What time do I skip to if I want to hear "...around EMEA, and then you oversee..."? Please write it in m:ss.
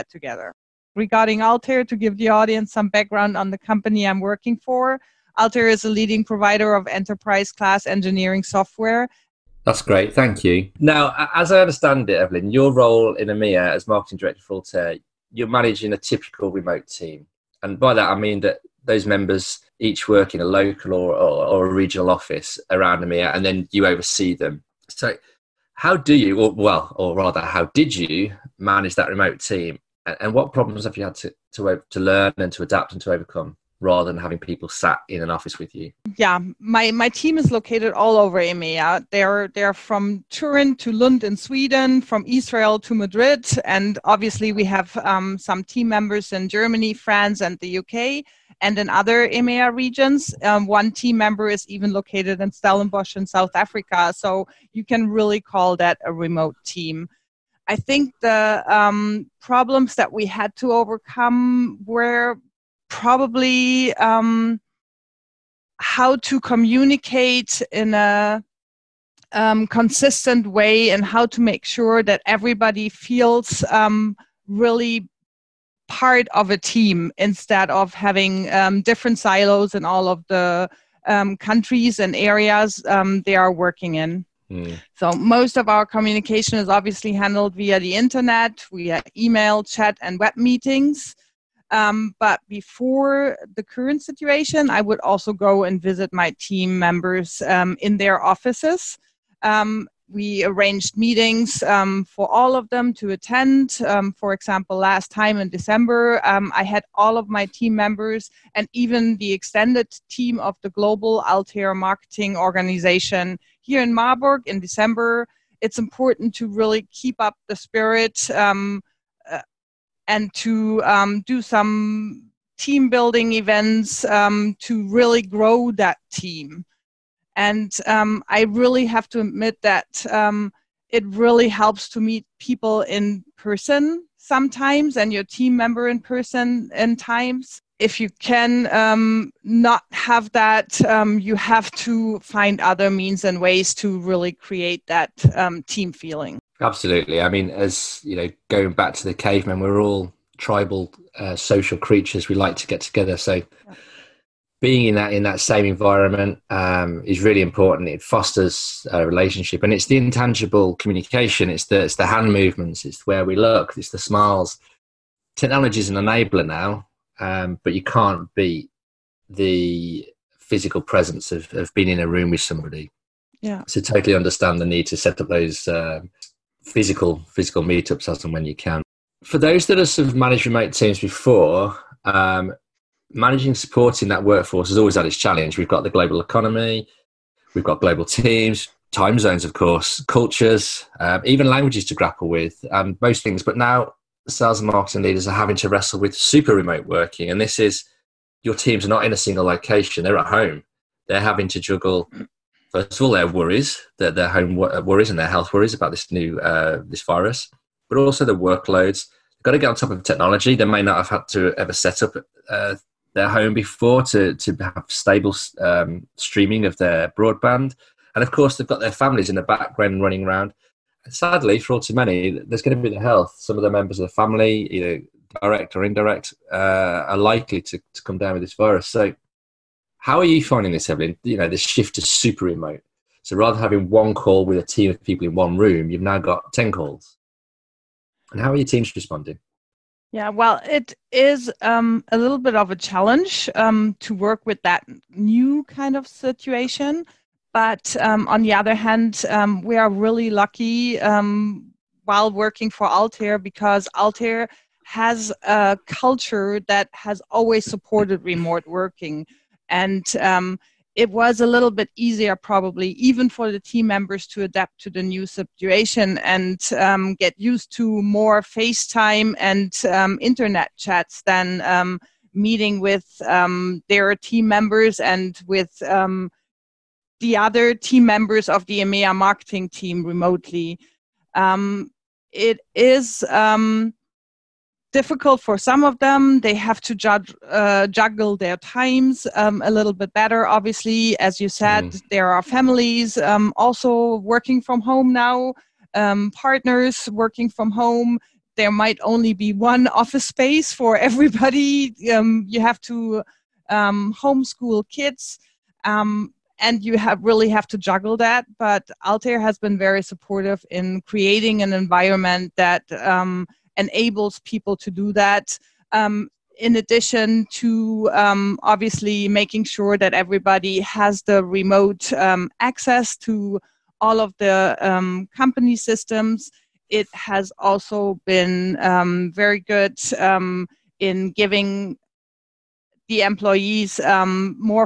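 0:22.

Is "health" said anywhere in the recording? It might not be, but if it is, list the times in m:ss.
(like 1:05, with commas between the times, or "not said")
3:25, 3:42.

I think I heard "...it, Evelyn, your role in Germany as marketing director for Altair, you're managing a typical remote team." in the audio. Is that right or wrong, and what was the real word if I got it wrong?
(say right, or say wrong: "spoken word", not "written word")
wrong: "EMEA", not "Germany".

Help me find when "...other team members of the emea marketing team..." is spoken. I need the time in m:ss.
4:37.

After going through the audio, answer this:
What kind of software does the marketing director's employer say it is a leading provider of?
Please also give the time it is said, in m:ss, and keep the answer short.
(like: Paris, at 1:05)
Enterprise class engineering software, at 0:06.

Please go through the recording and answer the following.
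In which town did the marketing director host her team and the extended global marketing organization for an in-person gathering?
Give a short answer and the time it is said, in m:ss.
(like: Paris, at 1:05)
Marburg, at 1:53.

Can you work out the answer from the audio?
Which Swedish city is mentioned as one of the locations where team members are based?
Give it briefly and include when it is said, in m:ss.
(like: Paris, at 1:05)
Lund, at 0:40.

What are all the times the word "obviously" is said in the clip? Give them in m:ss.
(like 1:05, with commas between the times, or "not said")
0:44, 1:26, 4:50, 5:18.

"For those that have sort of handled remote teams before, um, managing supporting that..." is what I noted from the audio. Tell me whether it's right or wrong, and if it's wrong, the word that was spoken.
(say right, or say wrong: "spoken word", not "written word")
wrong: "managed", not "handled".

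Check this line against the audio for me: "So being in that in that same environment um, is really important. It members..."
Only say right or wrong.
wrong.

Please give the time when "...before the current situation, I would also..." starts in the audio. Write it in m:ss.
1:32.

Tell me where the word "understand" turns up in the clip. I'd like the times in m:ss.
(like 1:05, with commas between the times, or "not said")
0:11, 2:54.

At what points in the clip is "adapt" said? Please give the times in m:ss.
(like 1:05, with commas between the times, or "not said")
0:32, 4:24.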